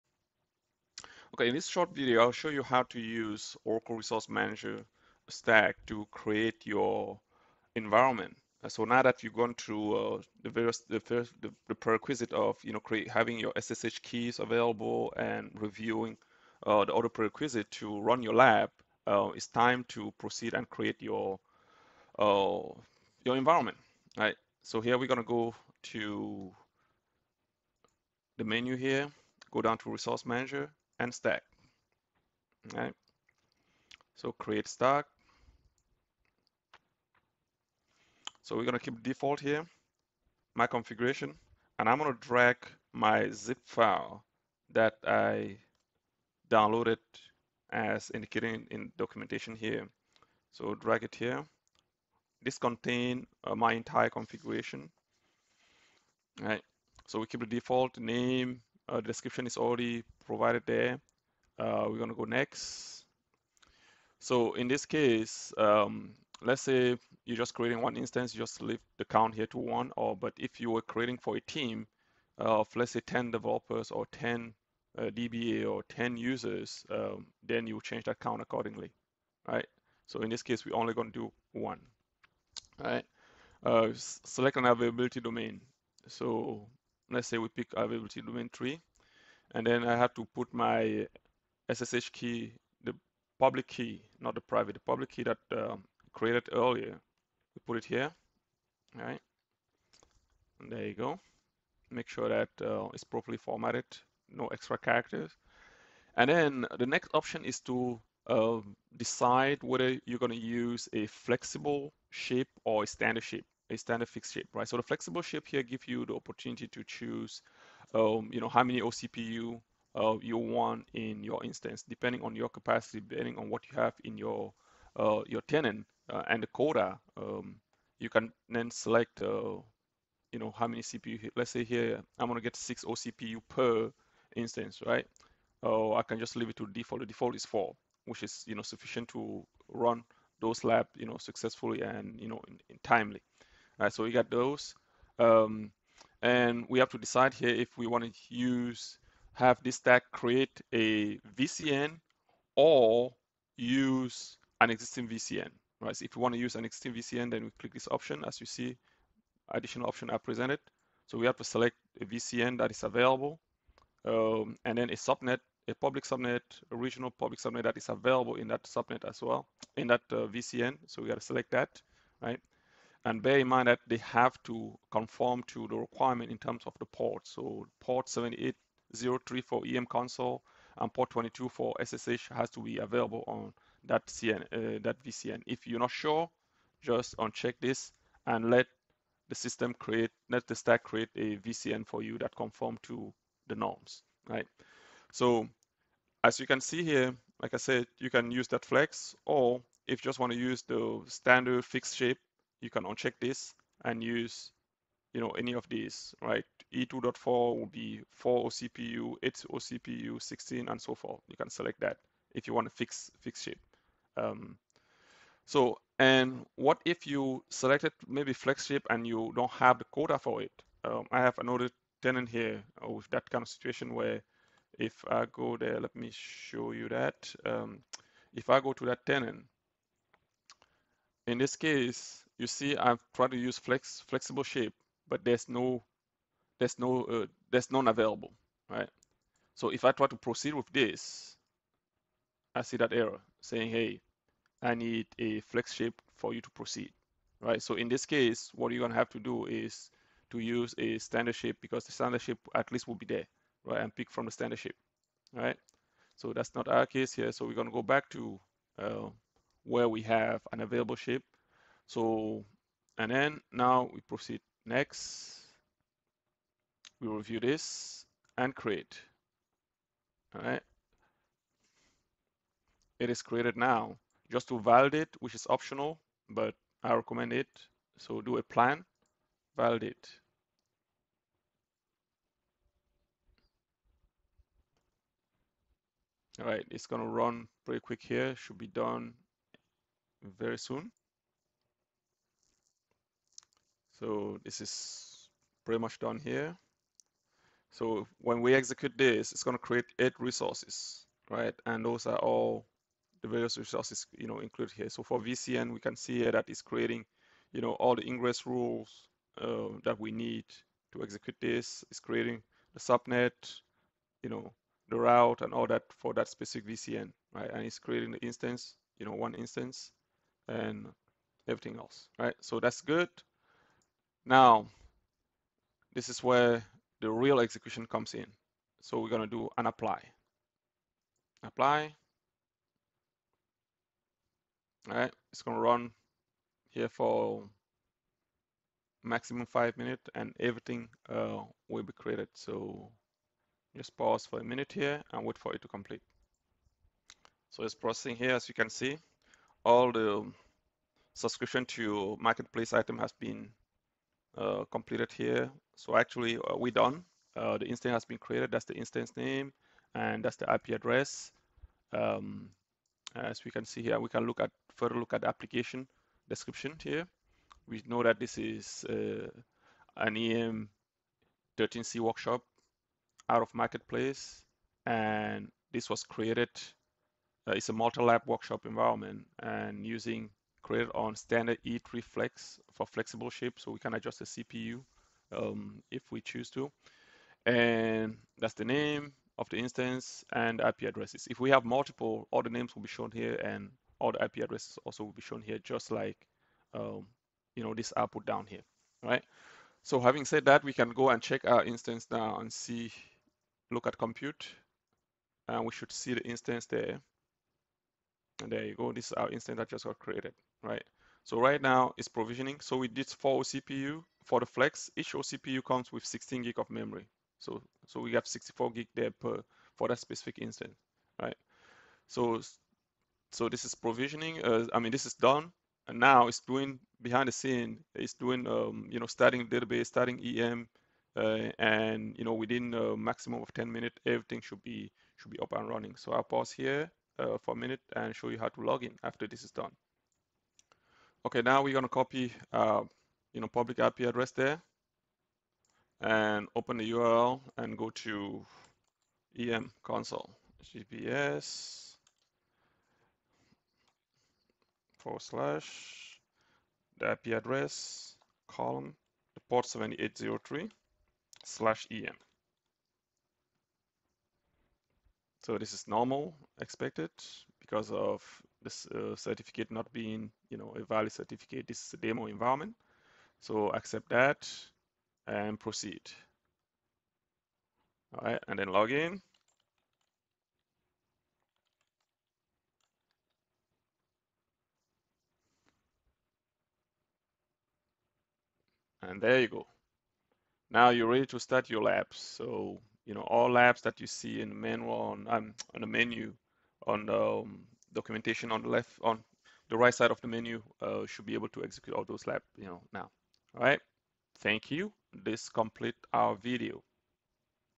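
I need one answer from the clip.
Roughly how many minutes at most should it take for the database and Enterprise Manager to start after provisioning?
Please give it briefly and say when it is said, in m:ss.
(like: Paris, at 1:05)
10 minutes, at 7:12.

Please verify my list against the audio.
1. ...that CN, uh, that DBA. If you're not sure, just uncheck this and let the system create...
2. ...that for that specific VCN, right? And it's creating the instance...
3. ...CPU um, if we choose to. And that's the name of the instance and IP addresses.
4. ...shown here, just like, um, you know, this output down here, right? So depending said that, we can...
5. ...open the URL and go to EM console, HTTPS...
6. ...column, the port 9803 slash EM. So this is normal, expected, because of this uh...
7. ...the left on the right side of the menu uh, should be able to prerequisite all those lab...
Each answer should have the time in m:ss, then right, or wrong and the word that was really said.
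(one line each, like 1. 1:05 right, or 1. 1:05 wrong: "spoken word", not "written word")
1. 3:03 wrong: "VCN", not "DBA"
2. 5:15 right
3. 6:24 right
4. 6:35 wrong: "having", not "depending"
5. 7:26 right
6. 7:38 wrong: "7803", not "9803"
7. 8:18 wrong: "execute", not "prerequisite".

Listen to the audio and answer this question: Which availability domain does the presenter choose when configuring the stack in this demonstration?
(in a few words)
Availability domain 3.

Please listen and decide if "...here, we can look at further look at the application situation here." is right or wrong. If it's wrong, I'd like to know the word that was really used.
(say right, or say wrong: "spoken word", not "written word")
wrong: "description", not "situation".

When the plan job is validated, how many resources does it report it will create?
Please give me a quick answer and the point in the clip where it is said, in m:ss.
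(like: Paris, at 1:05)
8, at 4:59.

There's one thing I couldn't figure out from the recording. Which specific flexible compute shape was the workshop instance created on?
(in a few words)
Standard E3 Flex.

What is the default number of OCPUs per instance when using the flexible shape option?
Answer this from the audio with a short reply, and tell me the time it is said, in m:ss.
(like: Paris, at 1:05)
4, at 2:17.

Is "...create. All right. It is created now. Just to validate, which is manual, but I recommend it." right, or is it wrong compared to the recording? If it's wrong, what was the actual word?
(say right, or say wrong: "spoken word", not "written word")
wrong: "optional", not "manual".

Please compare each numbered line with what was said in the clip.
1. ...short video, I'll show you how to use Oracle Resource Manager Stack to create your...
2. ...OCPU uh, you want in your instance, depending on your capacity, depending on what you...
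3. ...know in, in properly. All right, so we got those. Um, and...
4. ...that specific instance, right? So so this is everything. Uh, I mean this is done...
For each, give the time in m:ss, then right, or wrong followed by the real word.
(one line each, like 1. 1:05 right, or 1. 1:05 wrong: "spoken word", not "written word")
1. 0:01 right
2. 1:58 right
3. 2:22 wrong: "timely", not "properly"
4. 6:59 wrong: "provisioning", not "everything".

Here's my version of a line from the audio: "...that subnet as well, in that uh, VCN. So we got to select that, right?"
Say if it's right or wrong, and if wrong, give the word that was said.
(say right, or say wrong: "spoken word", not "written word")
right.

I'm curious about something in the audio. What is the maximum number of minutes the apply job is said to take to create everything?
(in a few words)
5.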